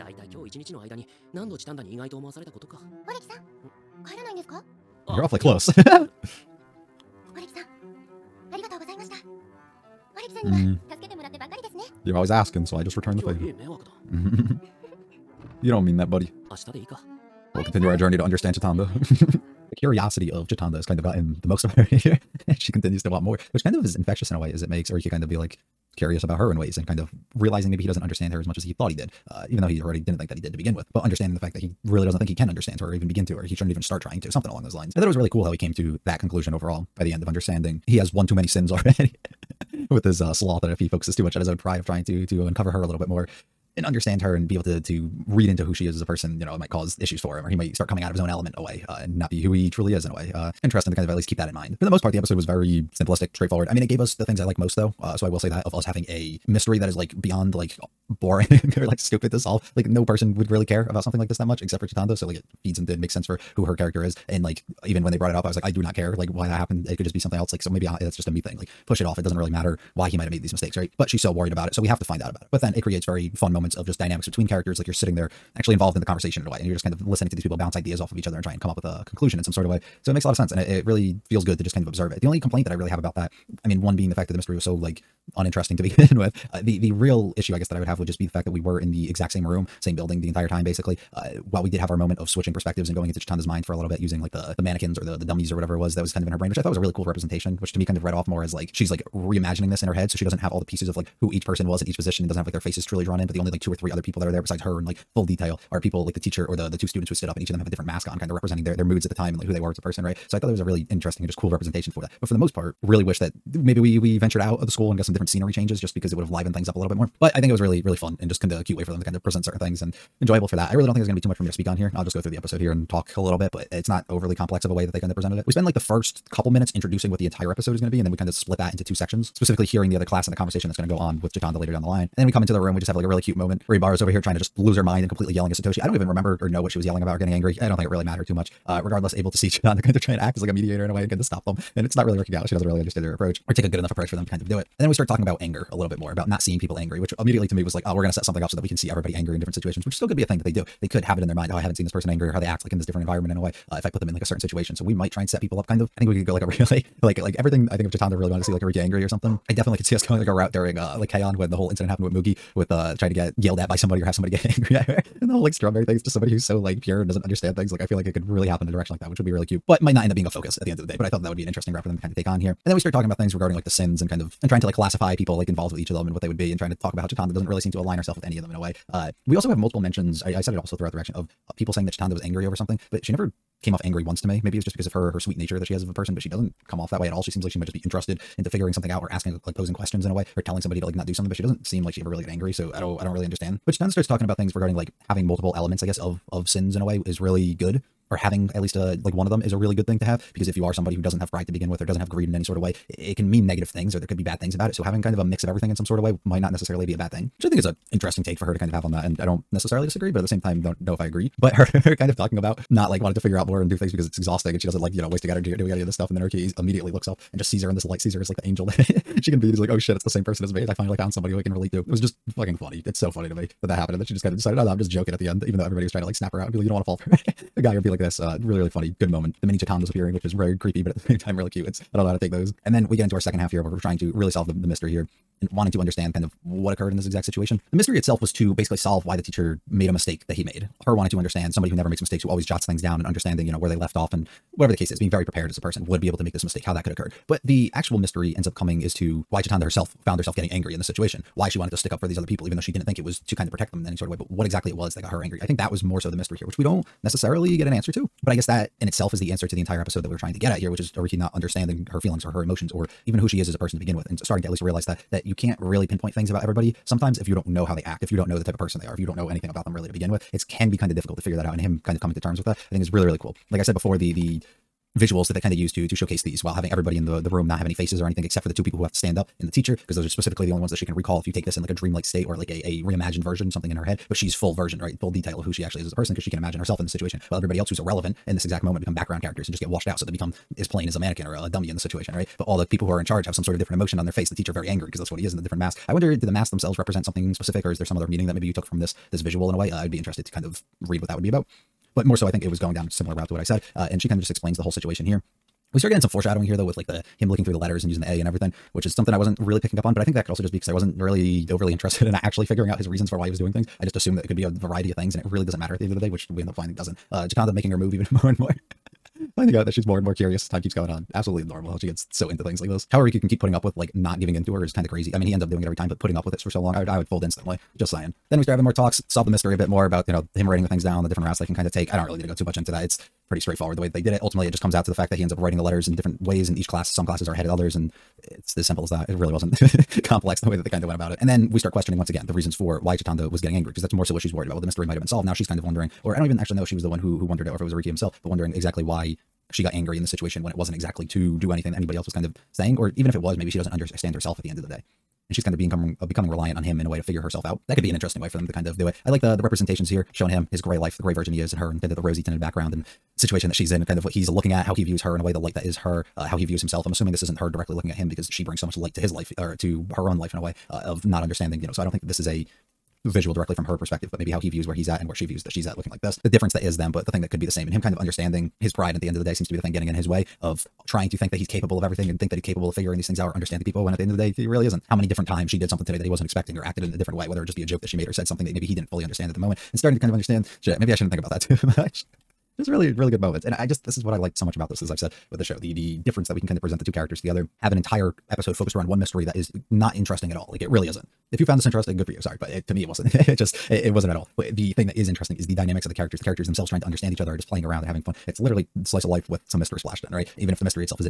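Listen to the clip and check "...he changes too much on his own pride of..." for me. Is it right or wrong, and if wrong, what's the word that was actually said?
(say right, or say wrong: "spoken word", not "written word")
wrong: "focuses", not "changes".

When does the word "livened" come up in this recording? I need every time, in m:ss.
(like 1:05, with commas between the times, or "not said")
1:56.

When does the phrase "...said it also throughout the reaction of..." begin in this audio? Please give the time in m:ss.
3:00.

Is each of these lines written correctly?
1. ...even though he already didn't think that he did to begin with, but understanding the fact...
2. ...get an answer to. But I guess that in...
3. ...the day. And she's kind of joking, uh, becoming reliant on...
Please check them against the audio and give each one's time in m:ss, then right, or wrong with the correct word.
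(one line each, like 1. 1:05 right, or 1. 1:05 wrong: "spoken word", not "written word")
1. 0:29 right
2. 4:17 right
3. 5:54 wrong: "becoming", not "joking".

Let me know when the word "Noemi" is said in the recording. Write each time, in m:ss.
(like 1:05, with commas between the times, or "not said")
not said.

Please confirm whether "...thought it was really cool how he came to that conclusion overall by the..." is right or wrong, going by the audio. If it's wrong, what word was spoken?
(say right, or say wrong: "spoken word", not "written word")
right.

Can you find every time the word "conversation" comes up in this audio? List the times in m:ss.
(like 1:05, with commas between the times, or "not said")
1:16, 2:10.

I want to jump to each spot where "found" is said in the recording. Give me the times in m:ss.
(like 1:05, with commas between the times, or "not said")
3:40, 4:10, 6:41.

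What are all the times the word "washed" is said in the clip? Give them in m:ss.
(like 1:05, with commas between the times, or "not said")
4:49.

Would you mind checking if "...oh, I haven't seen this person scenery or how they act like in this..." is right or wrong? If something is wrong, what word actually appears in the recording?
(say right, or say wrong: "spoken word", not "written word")
wrong: "angry", not "scenery".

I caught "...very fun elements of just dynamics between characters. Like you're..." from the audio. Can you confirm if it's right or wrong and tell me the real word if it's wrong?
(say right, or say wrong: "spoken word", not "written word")
wrong: "moments", not "elements".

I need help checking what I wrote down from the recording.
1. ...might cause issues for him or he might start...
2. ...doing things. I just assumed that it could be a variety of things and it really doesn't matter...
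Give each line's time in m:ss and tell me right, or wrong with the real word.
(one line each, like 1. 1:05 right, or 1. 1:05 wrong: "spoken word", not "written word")
1. 0:46 right
2. 5:13 right.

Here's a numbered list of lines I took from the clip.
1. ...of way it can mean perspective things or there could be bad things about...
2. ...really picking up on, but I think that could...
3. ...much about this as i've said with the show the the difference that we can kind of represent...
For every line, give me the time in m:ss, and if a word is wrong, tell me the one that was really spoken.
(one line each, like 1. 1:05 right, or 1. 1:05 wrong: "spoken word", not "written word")
1. 3:22 wrong: "negative", not "perspective"
2. 5:09 right
3. 6:34 wrong: "present", not "represent".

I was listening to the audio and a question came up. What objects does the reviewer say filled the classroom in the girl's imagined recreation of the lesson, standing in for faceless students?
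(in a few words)
mannequins.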